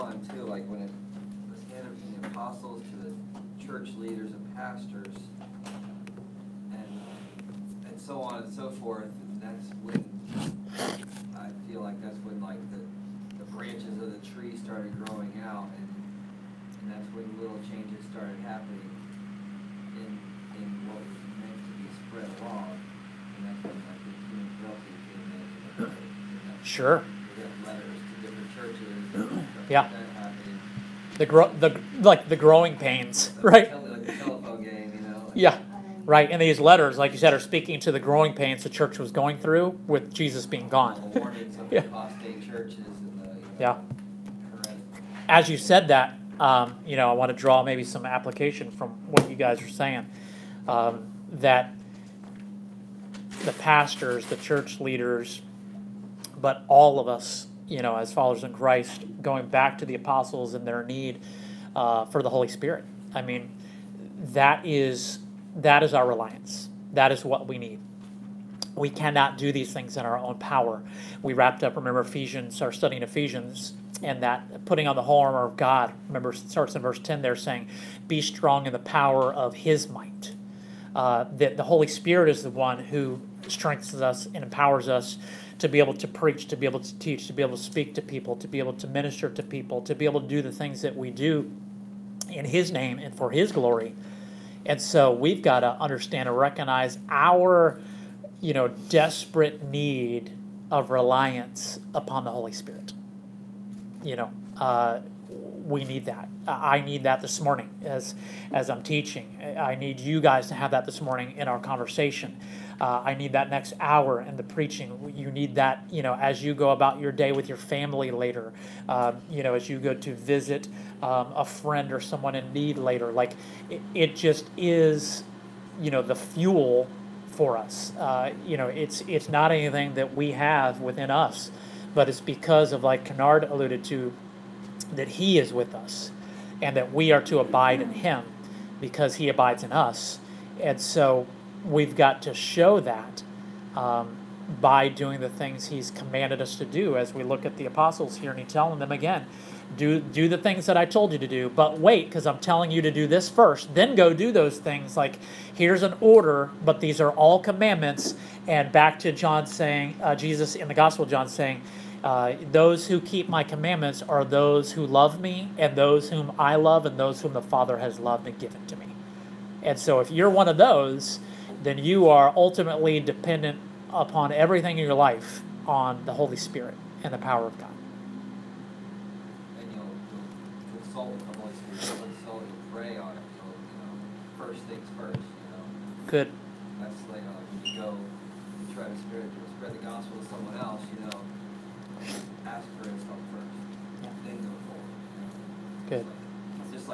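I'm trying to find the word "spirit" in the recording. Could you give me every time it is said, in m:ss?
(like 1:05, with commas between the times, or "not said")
1:02, 1:21, 1:42, 2:56, 3:01, 3:08.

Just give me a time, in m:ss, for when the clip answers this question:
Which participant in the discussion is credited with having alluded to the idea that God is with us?
2:13.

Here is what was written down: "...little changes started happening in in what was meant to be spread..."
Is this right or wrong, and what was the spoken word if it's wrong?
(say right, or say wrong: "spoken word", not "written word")
right.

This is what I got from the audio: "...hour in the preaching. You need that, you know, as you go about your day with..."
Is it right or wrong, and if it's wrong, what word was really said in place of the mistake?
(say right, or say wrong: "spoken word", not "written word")
right.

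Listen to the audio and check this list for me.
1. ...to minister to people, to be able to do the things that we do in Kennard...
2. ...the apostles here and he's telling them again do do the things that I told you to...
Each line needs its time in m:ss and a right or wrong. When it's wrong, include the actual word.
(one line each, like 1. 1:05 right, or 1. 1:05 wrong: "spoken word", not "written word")
1. 1:28 wrong: "His", not "Kennard"
2. 2:27 right.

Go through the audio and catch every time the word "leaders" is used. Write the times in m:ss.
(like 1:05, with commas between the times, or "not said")
0:03, 0:54.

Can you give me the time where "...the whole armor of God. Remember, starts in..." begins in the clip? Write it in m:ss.
1:14.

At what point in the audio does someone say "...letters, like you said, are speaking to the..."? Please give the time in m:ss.
0:36.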